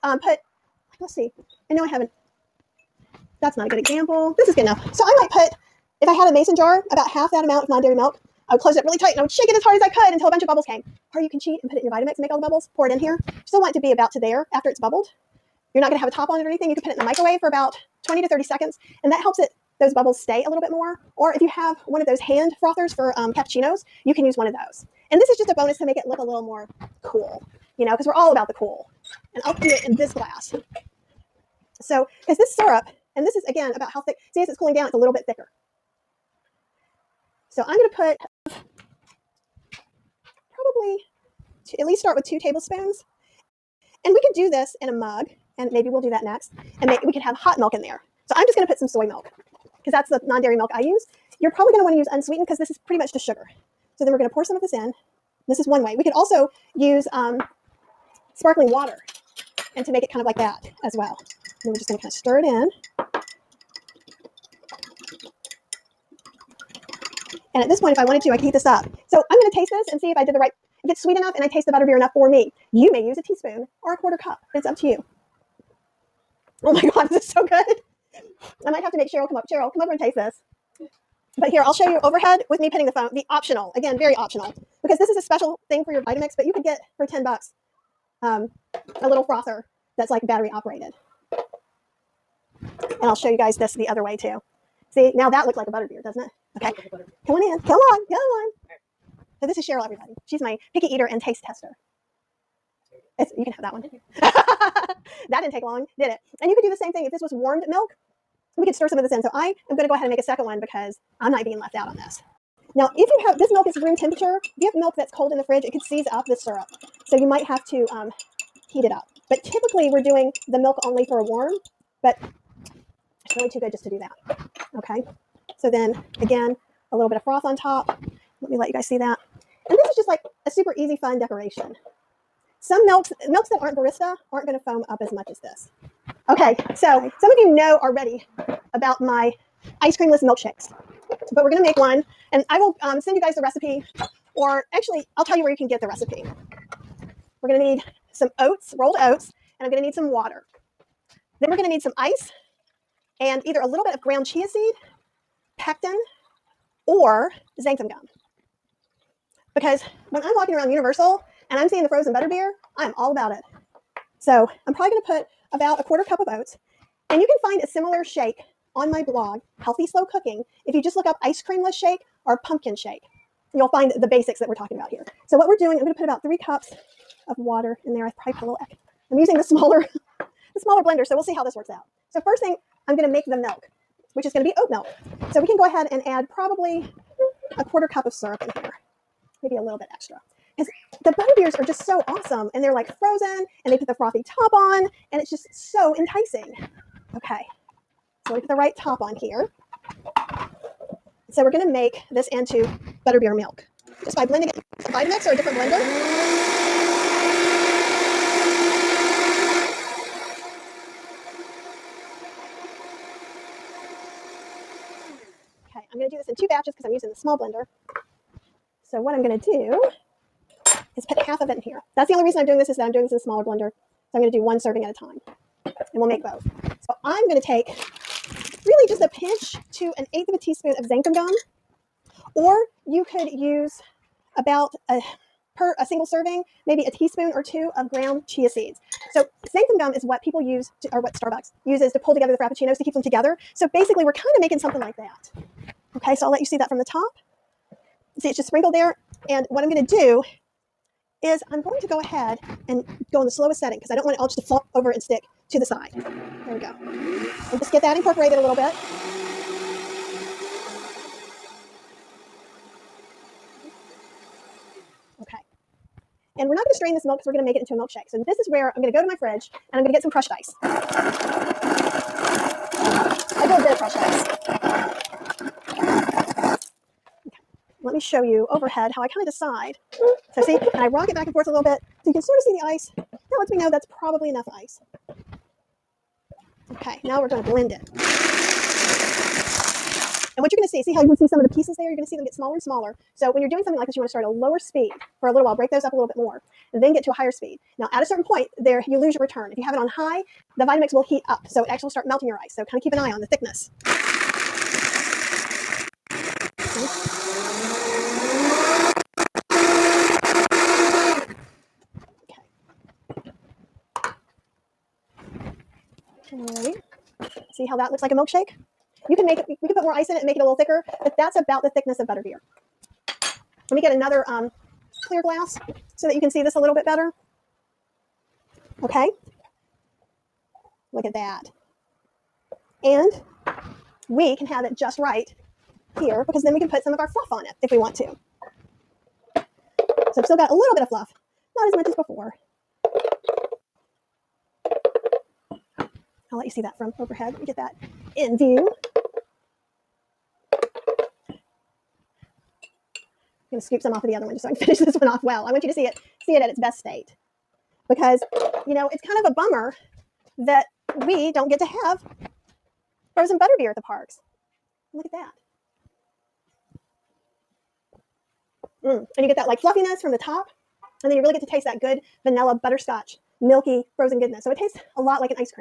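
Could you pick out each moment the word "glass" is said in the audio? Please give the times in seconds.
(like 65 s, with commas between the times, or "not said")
30 s, 325 s.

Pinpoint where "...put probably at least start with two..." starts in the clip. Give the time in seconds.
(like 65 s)
38 s.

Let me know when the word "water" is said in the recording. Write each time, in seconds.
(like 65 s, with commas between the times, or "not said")
58 s, 150 s, 177 s.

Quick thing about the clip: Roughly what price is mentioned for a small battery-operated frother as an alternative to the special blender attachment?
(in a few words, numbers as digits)
10 bucks.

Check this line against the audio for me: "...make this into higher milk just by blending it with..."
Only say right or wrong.
wrong.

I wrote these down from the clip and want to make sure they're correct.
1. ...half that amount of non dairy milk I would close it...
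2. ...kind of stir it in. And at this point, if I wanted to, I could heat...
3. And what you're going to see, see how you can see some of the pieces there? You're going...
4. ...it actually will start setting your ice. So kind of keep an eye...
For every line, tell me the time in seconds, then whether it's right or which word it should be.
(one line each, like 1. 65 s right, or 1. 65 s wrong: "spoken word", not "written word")
1. 7 s right
2. 62 s right
3. 290 s right
4. 301 s wrong: "melting", not "setting".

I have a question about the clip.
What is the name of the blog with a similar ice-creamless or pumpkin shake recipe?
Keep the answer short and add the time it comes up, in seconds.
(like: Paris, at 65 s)
Healthy Slow Cooking, at 169 s.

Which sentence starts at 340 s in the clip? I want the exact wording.
So I've still got a little bit of fluff, not as much as before.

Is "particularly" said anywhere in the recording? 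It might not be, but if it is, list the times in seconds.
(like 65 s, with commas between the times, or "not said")
not said.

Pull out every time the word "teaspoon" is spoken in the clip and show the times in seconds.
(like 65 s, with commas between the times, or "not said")
73 s, 230 s, 236 s.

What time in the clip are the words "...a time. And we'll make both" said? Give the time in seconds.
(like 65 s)
224 s.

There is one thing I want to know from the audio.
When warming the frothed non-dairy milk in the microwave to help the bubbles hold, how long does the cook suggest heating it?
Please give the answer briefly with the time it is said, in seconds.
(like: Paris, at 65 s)
20 to 30 seconds, at 18 s.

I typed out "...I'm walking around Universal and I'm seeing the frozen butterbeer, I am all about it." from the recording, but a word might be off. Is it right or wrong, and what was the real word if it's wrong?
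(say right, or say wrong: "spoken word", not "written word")
right.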